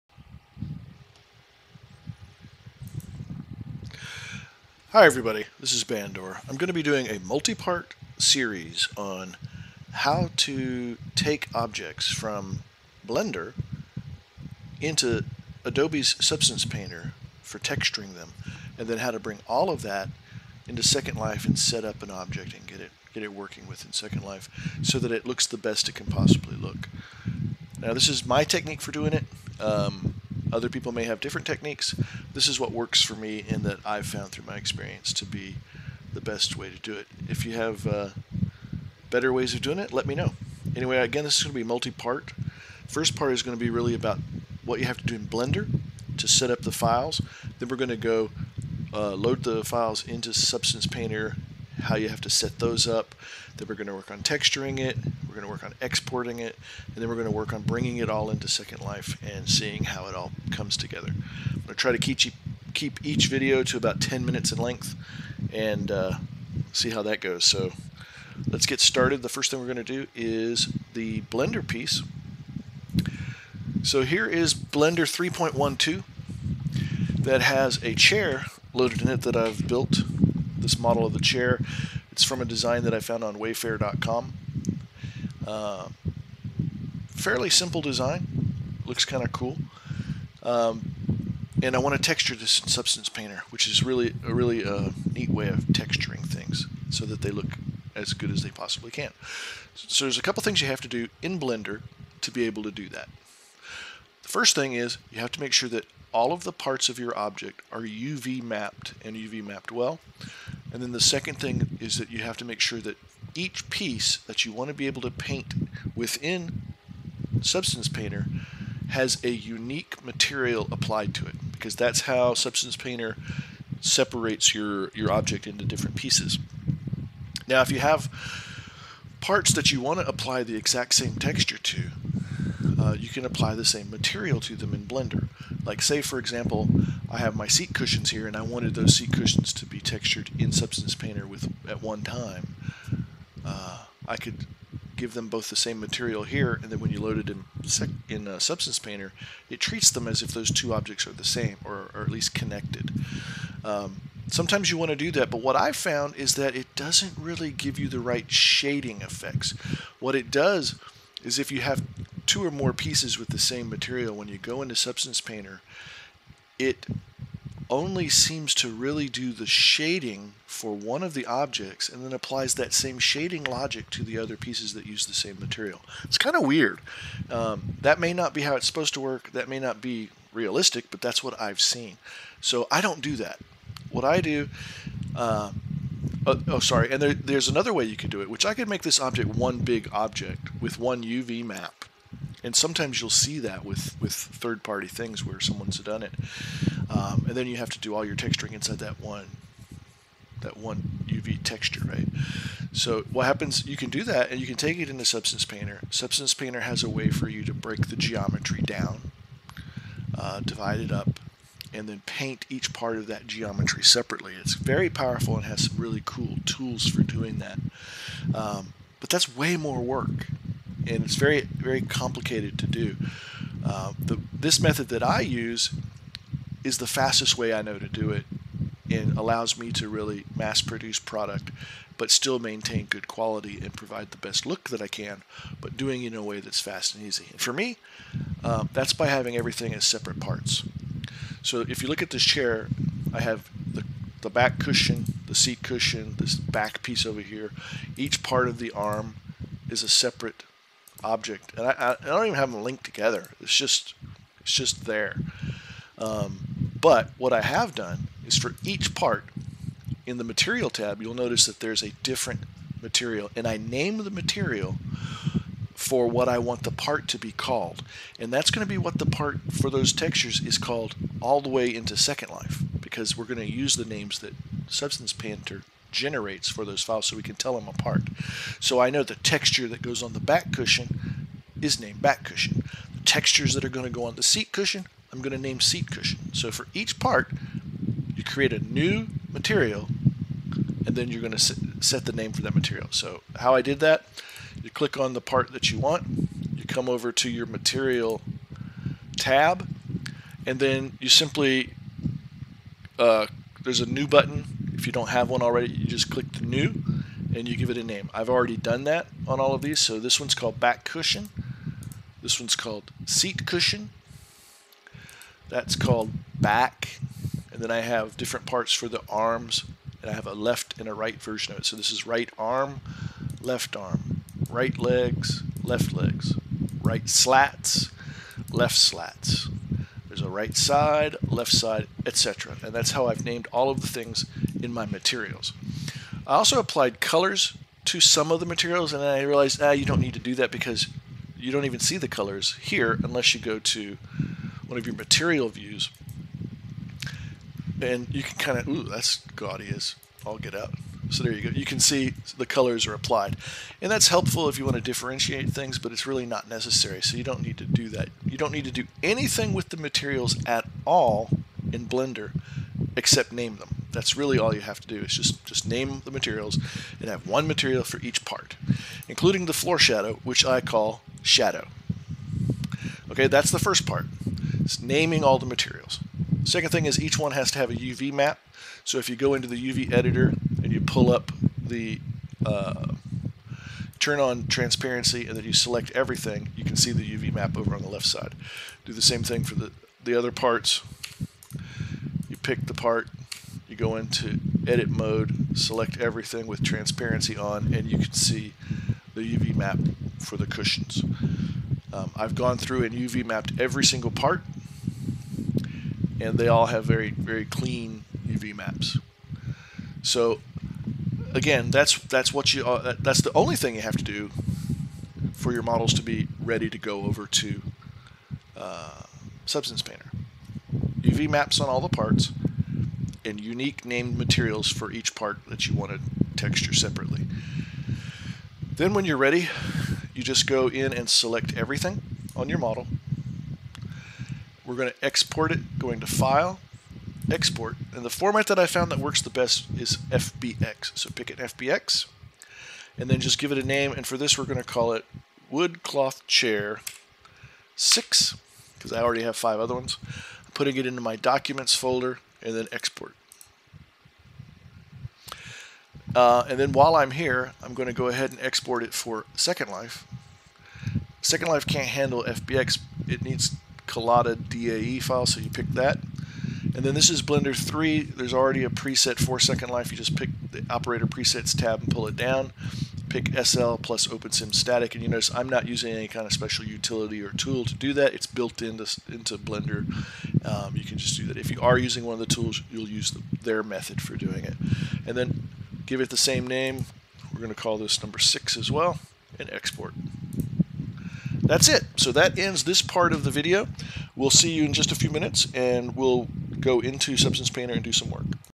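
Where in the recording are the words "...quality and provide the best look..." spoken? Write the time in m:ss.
3:53.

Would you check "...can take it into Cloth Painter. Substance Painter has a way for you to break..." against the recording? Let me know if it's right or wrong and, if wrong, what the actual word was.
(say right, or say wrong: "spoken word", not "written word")
wrong: "Substance", not "Cloth".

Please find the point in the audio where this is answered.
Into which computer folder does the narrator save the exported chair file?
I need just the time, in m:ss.
7:31.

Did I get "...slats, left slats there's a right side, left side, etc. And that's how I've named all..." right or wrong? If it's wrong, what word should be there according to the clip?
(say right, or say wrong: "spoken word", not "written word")
right.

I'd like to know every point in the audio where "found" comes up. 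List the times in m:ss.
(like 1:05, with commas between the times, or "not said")
0:34, 1:22, 2:35, 7:18.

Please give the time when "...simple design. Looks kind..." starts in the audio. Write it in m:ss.
1:27.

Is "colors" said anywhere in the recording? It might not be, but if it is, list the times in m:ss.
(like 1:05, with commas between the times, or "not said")
5:36, 5:42, 5:52.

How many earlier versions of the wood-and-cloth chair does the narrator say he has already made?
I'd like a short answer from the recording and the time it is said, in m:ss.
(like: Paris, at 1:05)
5, at 7:29.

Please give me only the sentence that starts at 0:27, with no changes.
Now this is my technique for doing it.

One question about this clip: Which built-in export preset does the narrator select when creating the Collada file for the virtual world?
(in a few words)
SL plus OpenSim static.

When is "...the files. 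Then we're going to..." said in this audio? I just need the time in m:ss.
0:46.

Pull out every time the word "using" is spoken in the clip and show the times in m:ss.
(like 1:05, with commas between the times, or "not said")
7:55, 8:01.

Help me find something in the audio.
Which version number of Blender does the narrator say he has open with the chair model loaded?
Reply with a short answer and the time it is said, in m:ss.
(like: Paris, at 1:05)
3.12, at 1:14.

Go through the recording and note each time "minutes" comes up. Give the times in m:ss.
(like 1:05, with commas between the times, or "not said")
1:04, 8:15.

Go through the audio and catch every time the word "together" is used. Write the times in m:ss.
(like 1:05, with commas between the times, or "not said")
1:00, 4:12.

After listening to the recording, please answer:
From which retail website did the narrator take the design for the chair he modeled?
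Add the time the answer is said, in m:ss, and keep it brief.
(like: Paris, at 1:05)
wayfair.com, at 1:23.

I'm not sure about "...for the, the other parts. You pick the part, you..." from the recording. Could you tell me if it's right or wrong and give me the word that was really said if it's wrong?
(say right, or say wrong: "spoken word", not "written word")
right.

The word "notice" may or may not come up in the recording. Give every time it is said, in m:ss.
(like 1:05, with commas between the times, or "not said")
4:21, 7:55.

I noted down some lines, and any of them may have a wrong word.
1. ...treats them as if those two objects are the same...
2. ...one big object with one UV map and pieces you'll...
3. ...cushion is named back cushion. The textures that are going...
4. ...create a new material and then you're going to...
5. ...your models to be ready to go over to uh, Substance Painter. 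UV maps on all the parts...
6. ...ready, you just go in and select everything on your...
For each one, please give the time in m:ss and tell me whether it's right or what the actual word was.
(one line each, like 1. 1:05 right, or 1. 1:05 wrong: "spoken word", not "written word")
1. 2:29 right
2. 3:09 wrong: "sometimes", not "pieces"
3. 4:40 right
4. 4:48 right
5. 6:55 right
6. 7:09 right.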